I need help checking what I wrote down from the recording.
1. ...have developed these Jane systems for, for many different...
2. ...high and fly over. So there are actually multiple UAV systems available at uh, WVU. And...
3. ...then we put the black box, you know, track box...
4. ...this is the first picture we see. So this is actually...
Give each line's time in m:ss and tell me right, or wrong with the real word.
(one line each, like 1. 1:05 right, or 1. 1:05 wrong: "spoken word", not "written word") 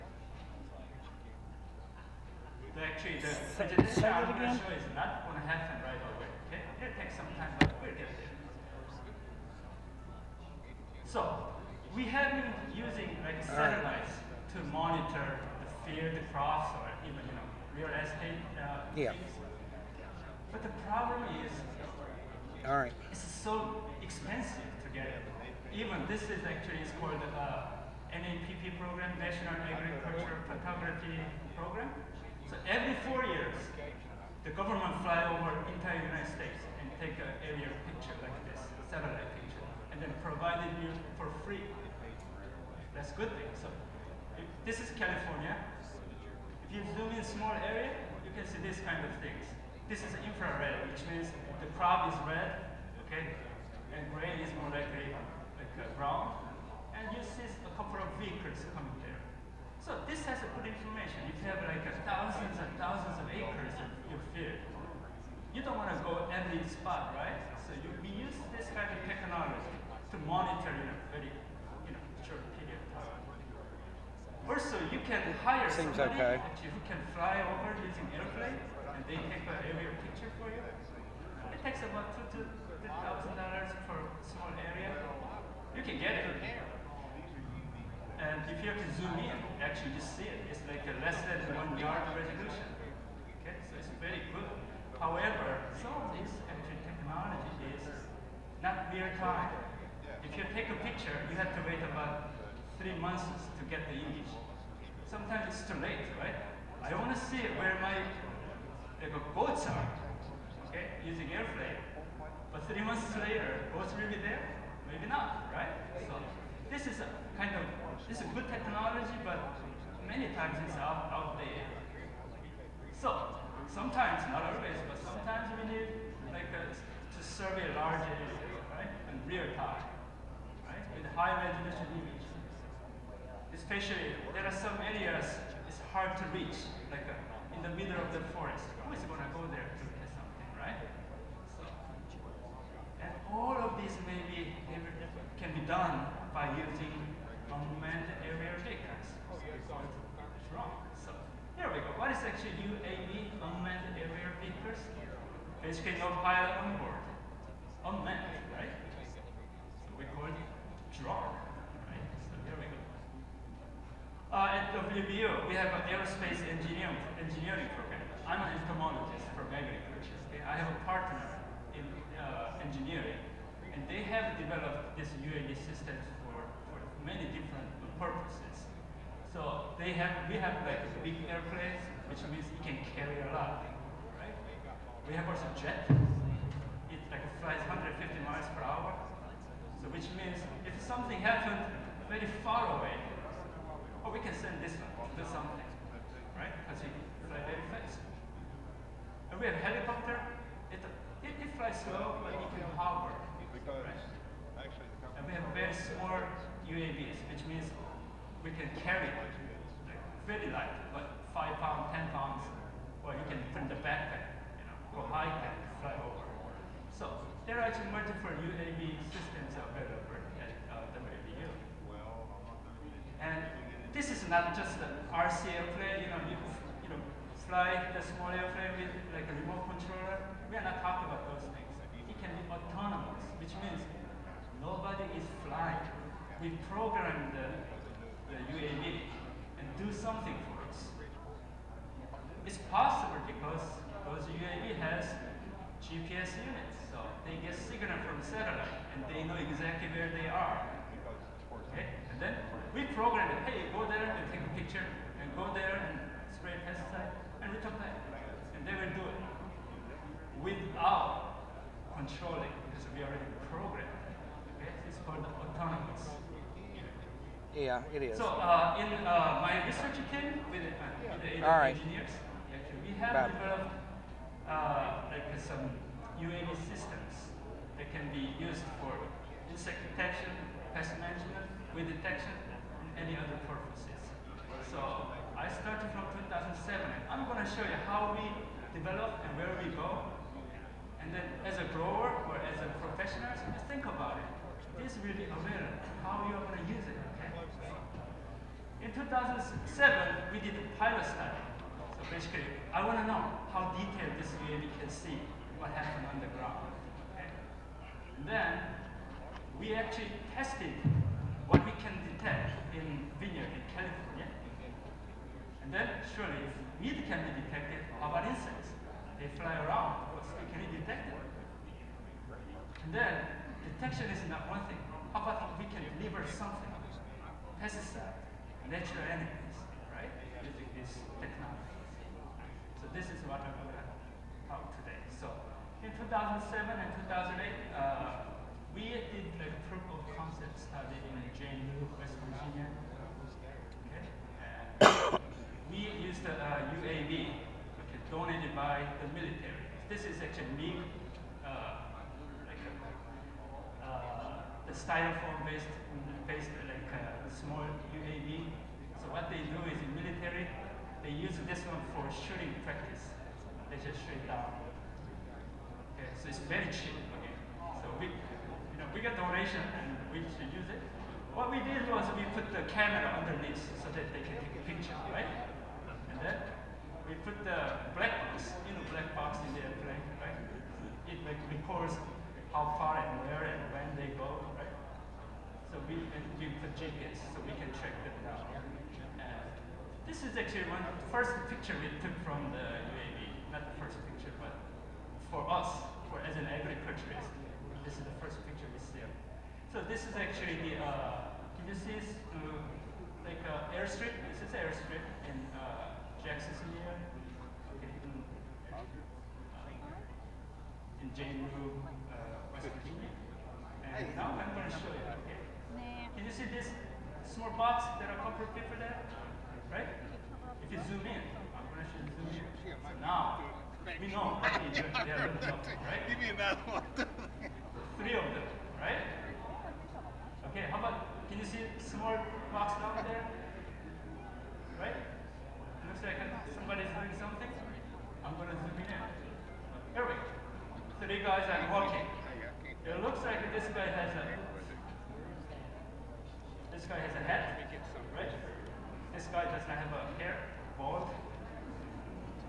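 1. 2:54 wrong: "UAV", not "Jane"
2. 3:35 right
3. 6:16 wrong: "black", not "track"
4. 6:37 right.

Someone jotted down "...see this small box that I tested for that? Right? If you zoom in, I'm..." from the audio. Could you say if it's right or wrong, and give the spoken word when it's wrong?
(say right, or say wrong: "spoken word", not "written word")
wrong: "covered", not "tested".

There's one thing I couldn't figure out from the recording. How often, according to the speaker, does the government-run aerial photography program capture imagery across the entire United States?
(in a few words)
every 4 years.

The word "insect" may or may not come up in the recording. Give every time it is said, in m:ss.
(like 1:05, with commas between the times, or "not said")
4:39, 5:18.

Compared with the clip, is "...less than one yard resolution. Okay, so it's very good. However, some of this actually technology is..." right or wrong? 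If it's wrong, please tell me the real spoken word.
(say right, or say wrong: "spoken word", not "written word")
right.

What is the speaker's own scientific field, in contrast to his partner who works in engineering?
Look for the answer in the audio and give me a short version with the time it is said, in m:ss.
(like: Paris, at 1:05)
entomologist, at 2:48.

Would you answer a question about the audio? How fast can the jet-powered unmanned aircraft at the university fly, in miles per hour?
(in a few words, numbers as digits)
150.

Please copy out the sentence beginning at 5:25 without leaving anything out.
How about we can deliver something?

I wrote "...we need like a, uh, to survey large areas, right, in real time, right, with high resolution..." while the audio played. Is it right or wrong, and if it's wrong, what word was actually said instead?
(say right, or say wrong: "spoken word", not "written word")
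right.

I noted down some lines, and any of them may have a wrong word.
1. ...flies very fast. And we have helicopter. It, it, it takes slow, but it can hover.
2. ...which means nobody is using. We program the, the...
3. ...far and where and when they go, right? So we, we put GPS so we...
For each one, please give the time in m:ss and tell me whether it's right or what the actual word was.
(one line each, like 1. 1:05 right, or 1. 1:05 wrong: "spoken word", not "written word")
1. 3:17 wrong: "flies", not "takes"
2. 3:53 wrong: "flying", not "using"
3. 6:22 right.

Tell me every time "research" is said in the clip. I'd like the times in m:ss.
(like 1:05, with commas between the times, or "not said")
4:29.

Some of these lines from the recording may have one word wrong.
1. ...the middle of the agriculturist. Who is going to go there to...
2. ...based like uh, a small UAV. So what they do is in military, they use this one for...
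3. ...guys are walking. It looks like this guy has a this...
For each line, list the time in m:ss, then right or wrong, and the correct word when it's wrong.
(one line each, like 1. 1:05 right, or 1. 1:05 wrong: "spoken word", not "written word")
1. 2:17 wrong: "forest", not "agriculturist"
2. 5:56 right
3. 7:21 right.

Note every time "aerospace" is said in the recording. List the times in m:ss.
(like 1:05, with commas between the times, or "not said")
2:45.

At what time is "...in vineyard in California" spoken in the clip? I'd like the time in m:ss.
5:12.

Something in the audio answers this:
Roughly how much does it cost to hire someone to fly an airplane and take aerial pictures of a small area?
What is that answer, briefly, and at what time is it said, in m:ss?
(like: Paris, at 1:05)
2,000 to 3,000 dollars, at 1:22.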